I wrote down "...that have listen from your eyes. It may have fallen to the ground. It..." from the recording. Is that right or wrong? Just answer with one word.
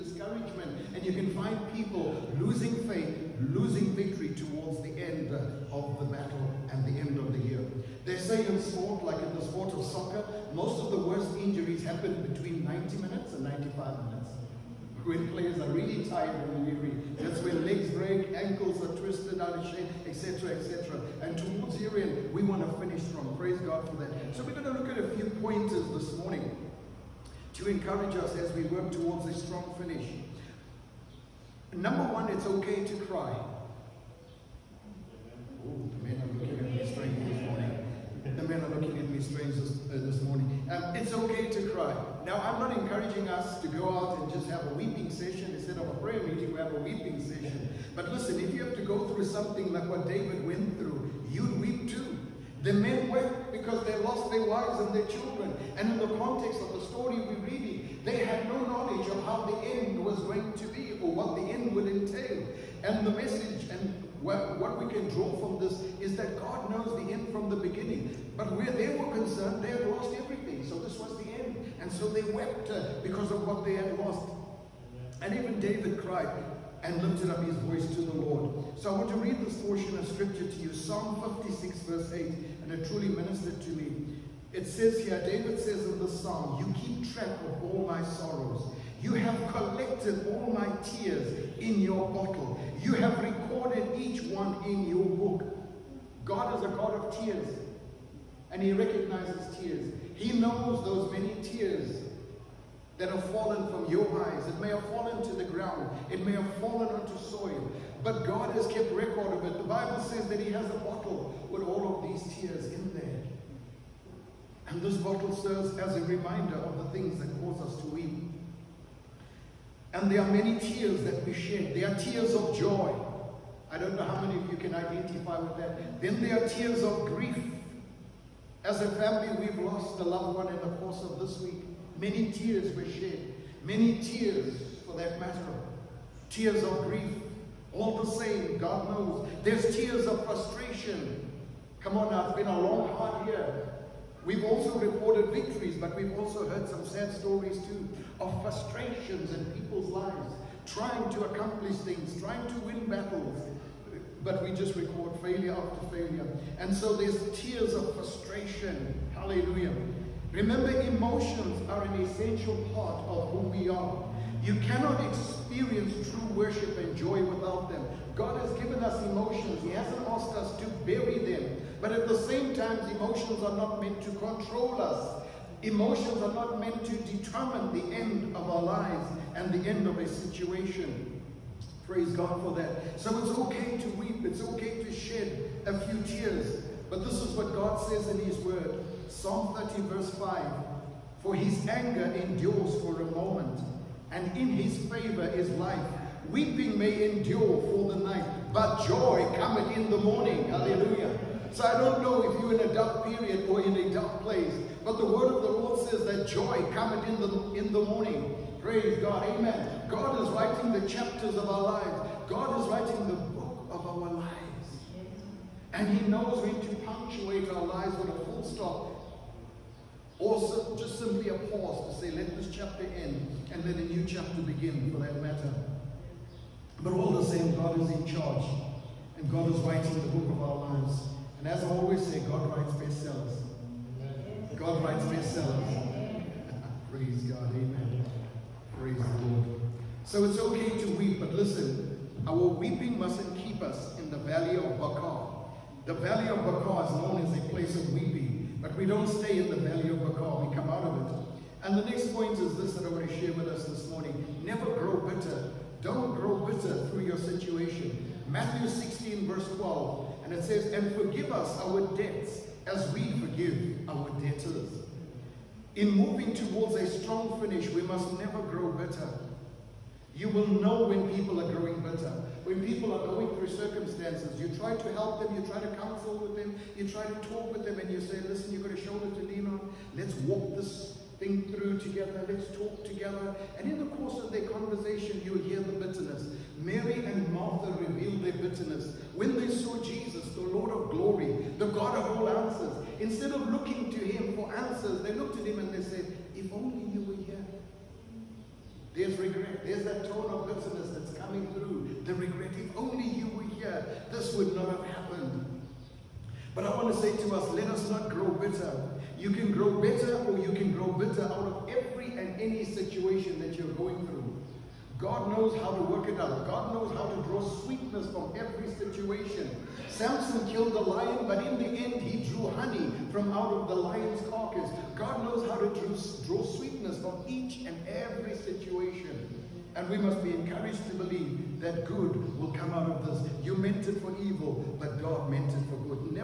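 wrong.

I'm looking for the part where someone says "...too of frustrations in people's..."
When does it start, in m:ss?
2:27.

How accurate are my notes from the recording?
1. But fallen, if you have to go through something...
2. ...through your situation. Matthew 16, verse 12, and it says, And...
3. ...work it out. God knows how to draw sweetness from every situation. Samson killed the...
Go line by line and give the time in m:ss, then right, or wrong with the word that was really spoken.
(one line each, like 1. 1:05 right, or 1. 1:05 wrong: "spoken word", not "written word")
1. 0:47 wrong: "listen", not "fallen"
2. 4:16 right
3. 5:15 right.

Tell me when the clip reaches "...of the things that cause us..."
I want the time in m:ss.
1:56.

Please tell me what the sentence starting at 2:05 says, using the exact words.
Then there are tears of grief.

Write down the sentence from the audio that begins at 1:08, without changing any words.
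But where they were concerned, they had lost everything.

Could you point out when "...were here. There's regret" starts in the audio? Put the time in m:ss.
4:57.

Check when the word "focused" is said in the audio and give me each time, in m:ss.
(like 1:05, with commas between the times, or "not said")
not said.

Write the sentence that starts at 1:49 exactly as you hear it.
The Bible says that he has a bottle with all of these tears in there.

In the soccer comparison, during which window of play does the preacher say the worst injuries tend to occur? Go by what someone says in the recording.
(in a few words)
90 to 95 minutes.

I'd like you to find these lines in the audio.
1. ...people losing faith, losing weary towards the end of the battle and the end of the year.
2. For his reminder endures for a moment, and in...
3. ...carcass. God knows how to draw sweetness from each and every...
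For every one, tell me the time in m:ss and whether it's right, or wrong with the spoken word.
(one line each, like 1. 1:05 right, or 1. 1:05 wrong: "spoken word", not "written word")
1. 0:01 wrong: "victory", not "weary"
2. 3:11 wrong: "anger", not "reminder"
3. 5:24 right.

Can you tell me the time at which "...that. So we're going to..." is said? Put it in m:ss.
0:23.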